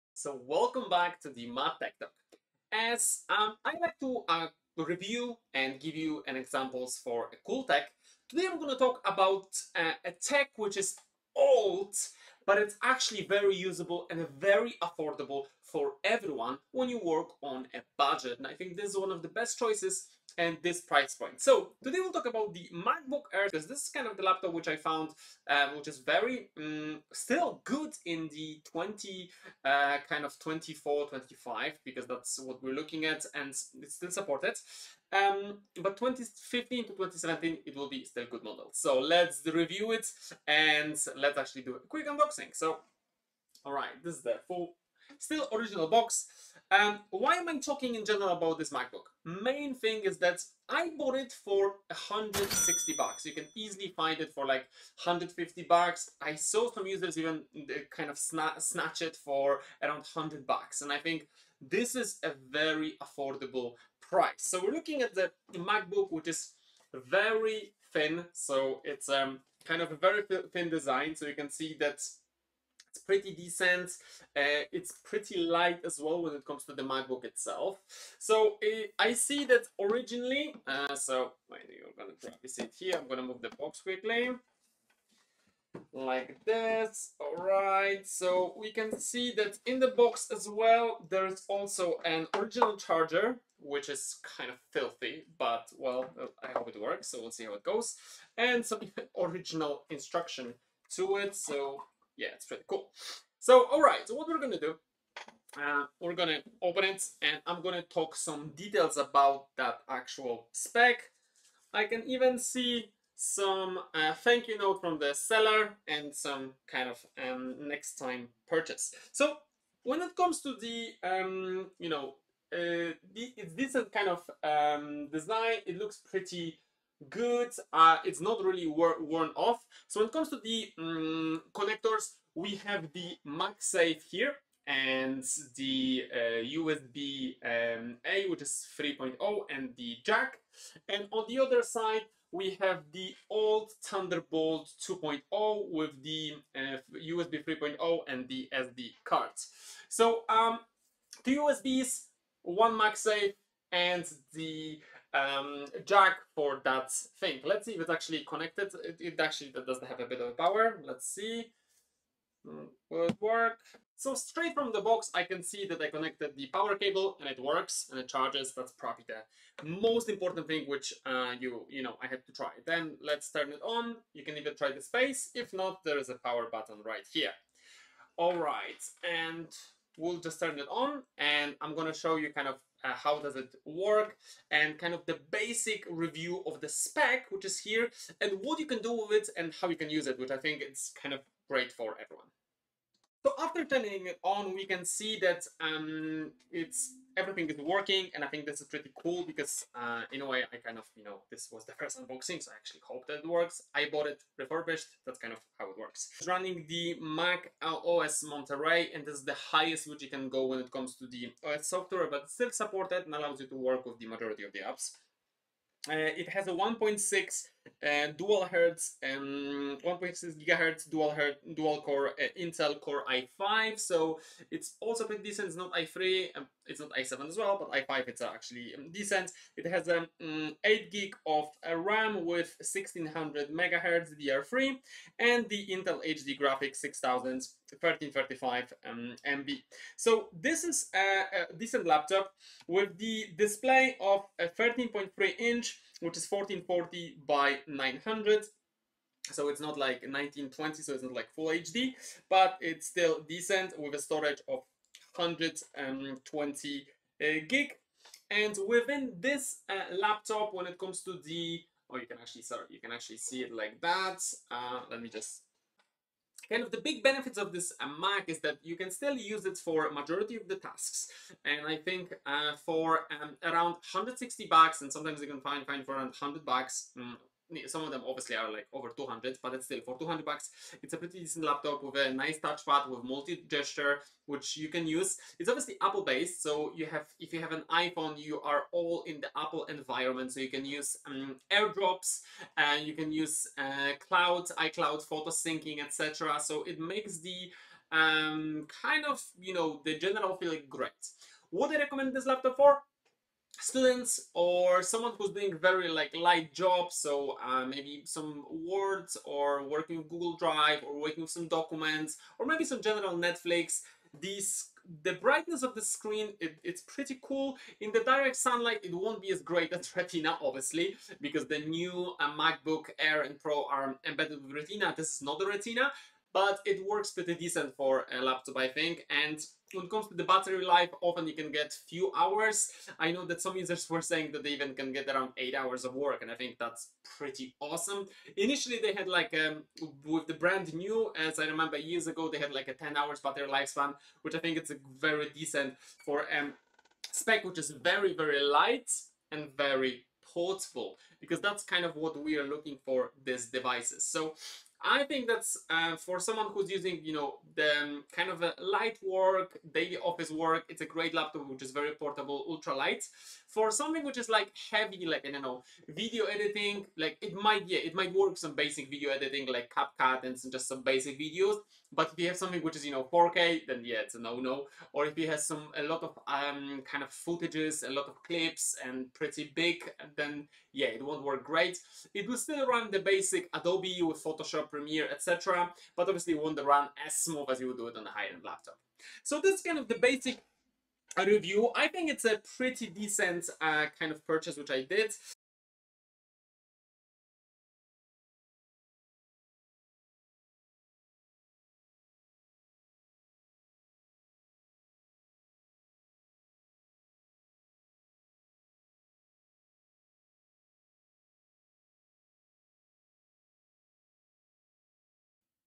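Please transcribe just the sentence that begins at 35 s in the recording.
Um, but 2015 to 2017 it will be still good model.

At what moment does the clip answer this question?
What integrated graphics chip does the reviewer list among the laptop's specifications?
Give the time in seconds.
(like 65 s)
235 s.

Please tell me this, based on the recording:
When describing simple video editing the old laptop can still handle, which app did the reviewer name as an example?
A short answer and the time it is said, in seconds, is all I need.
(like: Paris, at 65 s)
CapCut, at 369 s.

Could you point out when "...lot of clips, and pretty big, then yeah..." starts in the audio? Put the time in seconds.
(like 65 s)
377 s.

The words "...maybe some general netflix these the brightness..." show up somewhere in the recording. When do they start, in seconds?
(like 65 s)
312 s.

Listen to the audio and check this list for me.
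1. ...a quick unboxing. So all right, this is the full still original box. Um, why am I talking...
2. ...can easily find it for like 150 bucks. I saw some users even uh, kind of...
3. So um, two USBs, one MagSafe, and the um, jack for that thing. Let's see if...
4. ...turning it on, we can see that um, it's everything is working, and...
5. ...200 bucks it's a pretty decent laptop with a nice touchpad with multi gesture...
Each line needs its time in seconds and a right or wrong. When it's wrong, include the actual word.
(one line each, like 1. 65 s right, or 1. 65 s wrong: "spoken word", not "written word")
1. 41 s right
2. 53 s right
3. 149 s right
4. 193 s right
5. 279 s right.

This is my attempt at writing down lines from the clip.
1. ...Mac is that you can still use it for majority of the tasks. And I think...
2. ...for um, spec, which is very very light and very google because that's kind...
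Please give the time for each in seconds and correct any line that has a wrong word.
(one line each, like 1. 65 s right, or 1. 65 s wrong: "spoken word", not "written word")
1. 267 s right
2. 346 s wrong: "portable", not "google".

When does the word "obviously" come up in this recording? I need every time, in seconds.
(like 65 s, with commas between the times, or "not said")
278 s, 285 s, 320 s, 386 s.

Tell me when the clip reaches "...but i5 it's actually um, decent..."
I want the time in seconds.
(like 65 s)
227 s.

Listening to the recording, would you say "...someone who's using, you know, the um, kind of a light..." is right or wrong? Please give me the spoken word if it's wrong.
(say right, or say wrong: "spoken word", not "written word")
right.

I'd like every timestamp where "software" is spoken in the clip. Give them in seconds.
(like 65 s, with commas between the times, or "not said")
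211 s.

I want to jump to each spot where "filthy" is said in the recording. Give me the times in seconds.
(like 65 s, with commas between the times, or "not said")
94 s.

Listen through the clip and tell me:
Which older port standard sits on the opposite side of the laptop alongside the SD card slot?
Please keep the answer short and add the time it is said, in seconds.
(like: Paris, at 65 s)
Thunderbolt 2.0, at 143 s.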